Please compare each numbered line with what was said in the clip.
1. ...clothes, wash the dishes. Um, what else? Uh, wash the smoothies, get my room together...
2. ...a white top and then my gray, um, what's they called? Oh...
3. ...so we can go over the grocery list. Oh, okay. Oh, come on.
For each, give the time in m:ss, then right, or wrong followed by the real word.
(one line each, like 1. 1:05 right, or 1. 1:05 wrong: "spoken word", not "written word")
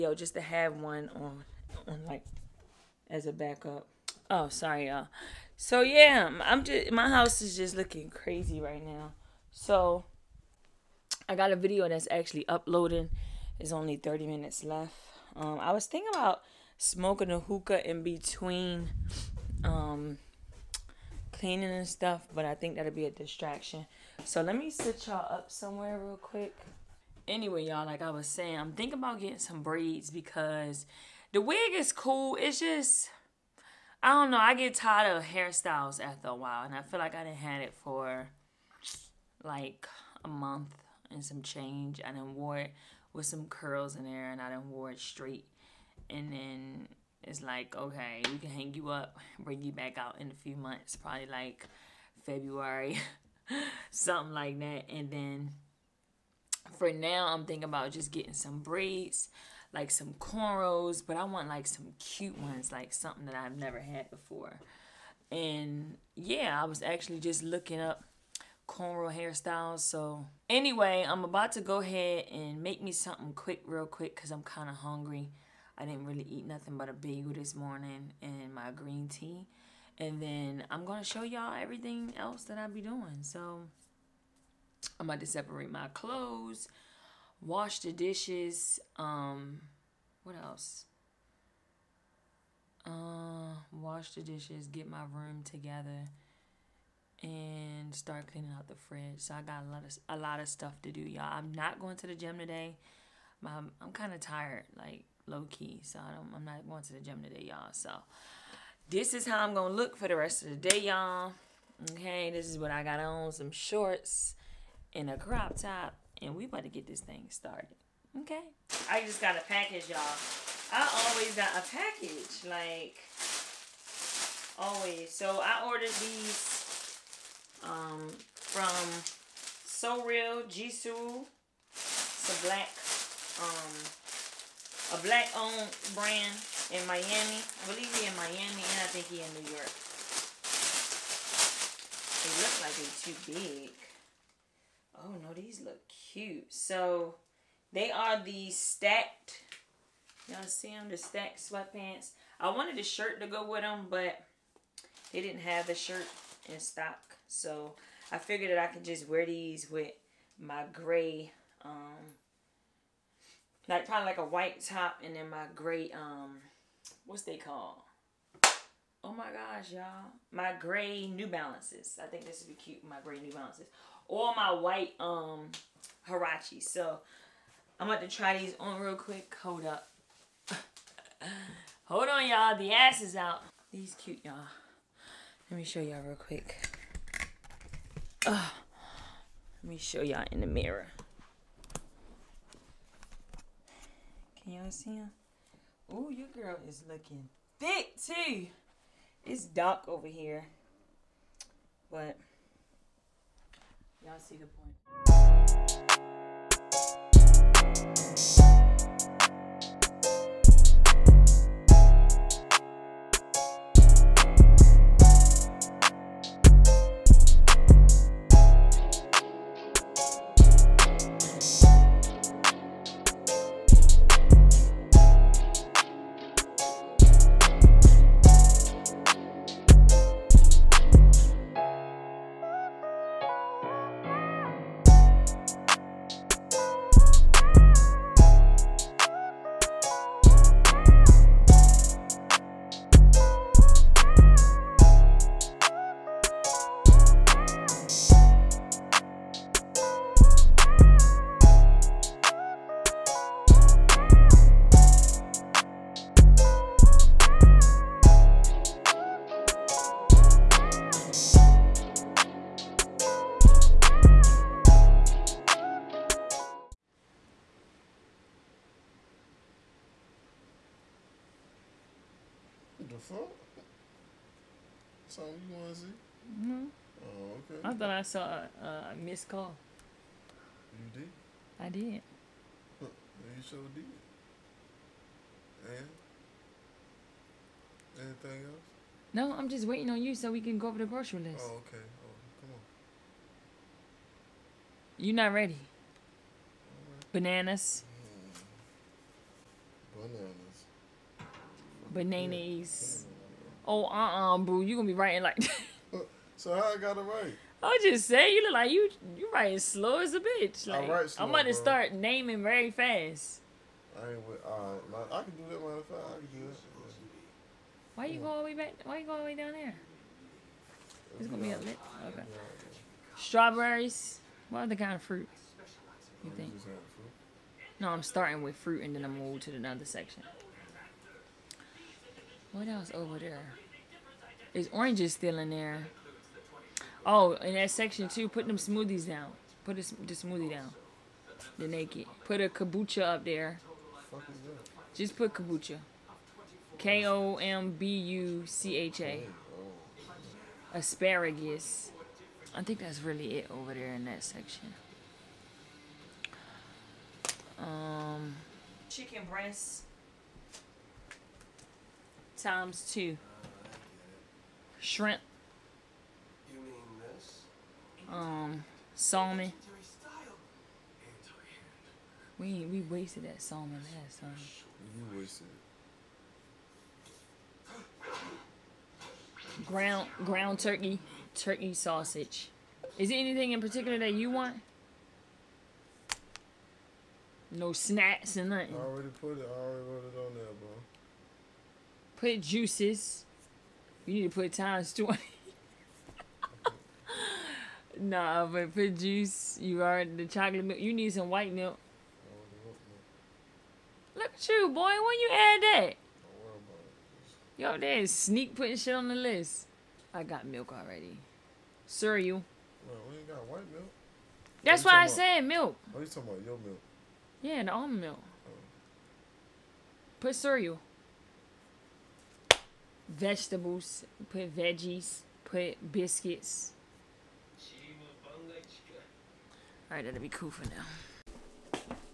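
1. 1:25 wrong: "dishes", not "smoothies"
2. 2:44 right
3. 4:50 right.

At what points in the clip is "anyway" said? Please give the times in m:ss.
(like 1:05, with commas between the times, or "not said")
0:27, 1:10.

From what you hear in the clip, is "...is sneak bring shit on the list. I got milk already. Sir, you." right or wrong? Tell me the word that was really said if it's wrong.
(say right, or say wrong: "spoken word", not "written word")
wrong: "putting", not "bring".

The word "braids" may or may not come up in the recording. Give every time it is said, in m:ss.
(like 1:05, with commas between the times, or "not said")
0:29, 0:58.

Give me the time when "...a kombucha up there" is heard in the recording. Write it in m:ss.
5:42.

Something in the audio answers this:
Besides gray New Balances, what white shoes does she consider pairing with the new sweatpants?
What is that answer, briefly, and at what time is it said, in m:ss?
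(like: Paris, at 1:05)
Huarache, at 2:56.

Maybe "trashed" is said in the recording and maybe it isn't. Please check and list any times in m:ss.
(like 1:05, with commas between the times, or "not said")
not said.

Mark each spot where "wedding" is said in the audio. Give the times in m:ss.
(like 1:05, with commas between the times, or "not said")
not said.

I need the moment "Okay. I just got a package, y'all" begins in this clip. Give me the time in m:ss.
1:58.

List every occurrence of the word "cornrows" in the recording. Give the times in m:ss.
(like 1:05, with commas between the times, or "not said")
1:00, 1:08.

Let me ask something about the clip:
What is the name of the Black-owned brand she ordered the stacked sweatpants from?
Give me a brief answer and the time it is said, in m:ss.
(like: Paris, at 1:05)
So Real Jisoo, at 2:09.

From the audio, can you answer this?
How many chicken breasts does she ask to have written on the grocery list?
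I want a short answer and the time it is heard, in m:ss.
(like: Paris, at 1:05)
2, at 6:02.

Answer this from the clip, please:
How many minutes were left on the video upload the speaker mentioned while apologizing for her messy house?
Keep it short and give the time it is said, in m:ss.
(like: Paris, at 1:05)
30, at 0:13.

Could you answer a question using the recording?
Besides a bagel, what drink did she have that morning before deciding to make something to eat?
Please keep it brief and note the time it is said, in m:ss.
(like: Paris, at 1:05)
green tea, at 1:18.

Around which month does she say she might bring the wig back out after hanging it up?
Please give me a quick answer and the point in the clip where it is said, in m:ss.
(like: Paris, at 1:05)
February, at 0:52.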